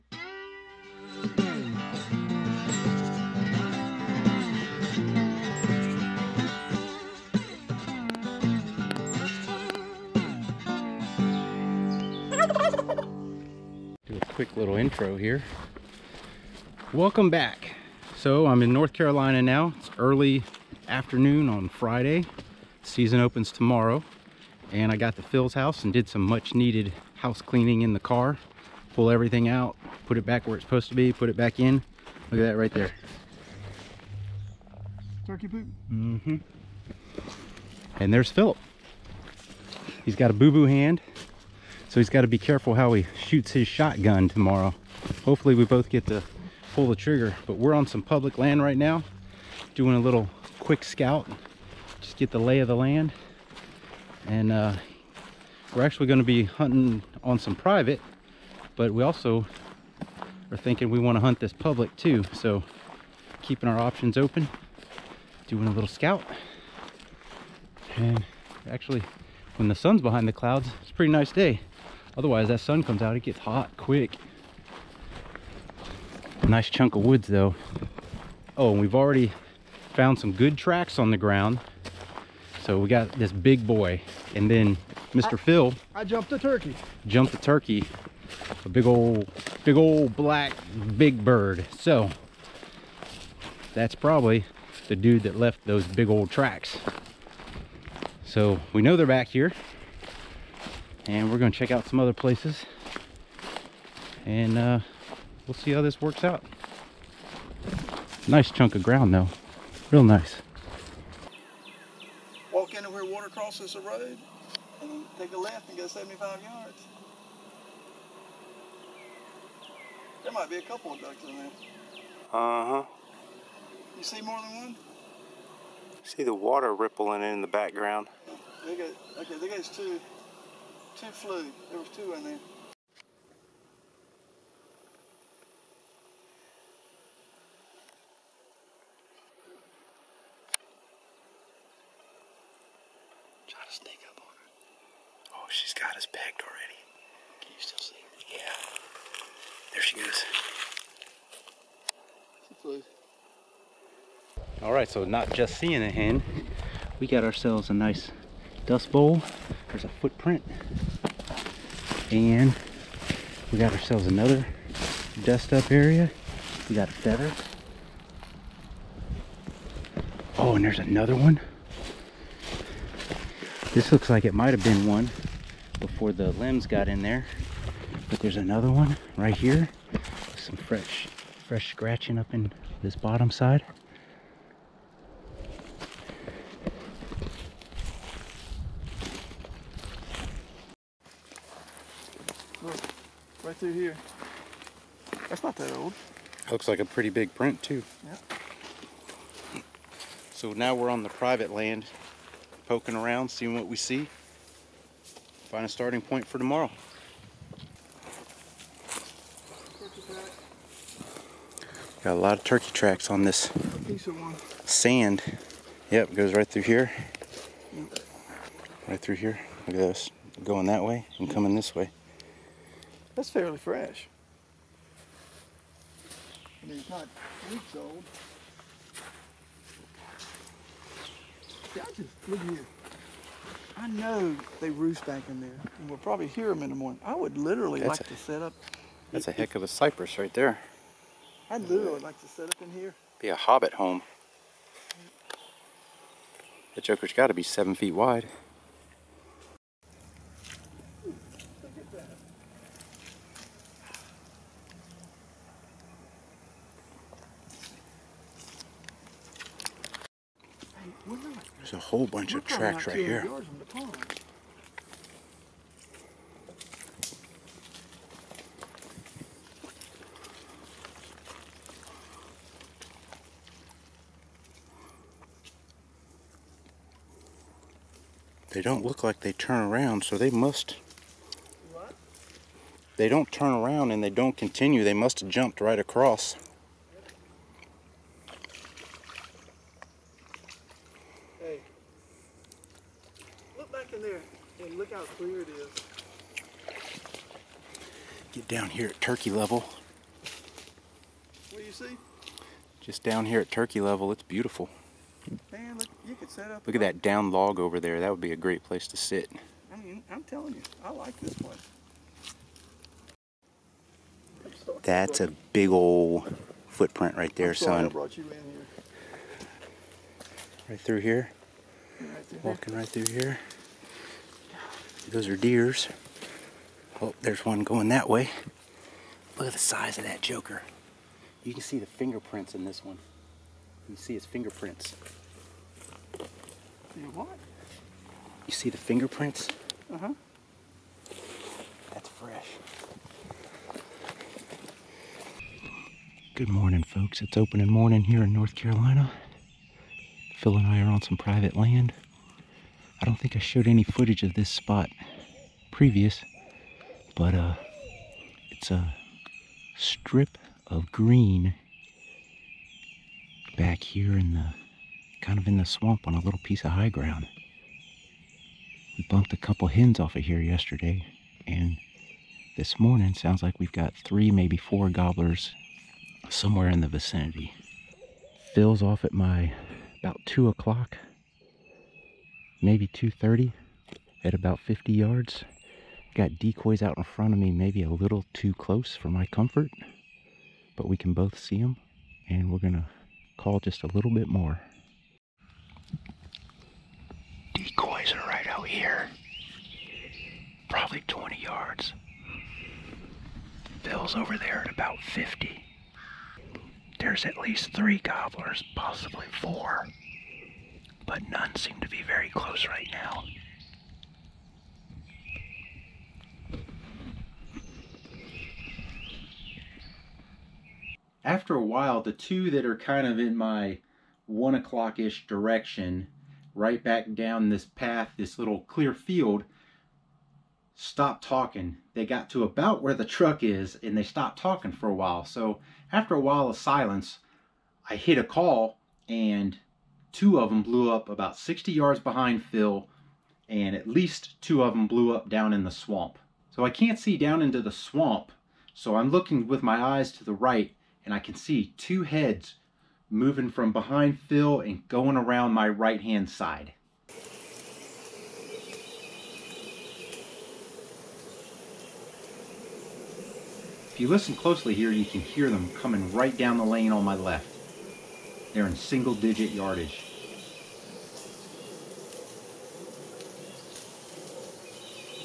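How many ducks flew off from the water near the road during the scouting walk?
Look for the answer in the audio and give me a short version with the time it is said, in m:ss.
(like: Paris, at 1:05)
2, at 2:11.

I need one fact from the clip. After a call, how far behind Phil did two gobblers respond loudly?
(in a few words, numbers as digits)
60 yards.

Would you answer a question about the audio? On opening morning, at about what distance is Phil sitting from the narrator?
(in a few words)
50 yards.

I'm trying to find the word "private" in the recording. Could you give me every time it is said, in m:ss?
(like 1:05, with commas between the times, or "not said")
0:57, 3:21, 5:51.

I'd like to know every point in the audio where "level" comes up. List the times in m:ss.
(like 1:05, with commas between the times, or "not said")
4:59, 5:03.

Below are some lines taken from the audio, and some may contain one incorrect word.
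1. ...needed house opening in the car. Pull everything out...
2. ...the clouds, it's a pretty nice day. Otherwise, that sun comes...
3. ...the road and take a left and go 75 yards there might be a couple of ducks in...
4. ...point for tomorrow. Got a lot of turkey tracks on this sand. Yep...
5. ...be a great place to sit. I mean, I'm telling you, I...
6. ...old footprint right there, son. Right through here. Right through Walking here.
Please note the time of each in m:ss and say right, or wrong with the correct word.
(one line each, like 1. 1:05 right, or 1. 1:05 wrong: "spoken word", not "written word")
1. 0:26 wrong: "cleaning", not "opening"
2. 1:10 right
3. 1:53 right
4. 3:26 right
5. 5:08 right
6. 5:15 right.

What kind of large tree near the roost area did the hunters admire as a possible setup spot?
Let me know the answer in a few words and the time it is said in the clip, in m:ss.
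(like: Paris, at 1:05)
Cypress, at 3:59.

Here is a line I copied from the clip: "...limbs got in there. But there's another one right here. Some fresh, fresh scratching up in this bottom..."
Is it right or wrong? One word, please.
right.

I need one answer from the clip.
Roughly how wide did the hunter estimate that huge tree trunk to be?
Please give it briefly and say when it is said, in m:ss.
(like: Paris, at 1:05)
7 feet, at 4:07.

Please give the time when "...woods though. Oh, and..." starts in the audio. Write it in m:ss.
1:17.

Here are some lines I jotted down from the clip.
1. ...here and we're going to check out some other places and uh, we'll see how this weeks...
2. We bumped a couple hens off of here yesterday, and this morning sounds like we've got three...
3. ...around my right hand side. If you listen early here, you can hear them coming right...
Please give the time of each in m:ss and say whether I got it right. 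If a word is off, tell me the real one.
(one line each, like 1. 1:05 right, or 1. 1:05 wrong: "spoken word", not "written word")
1. 1:39 wrong: "works", not "weeks"
2. 6:08 right
3. 7:35 wrong: "closely", not "early".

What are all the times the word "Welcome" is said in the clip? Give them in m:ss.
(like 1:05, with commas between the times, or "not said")
0:16.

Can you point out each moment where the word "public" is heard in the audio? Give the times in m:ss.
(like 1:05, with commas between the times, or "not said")
0:48, 1:01.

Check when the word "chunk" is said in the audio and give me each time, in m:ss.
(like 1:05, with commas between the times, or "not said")
1:16, 1:48.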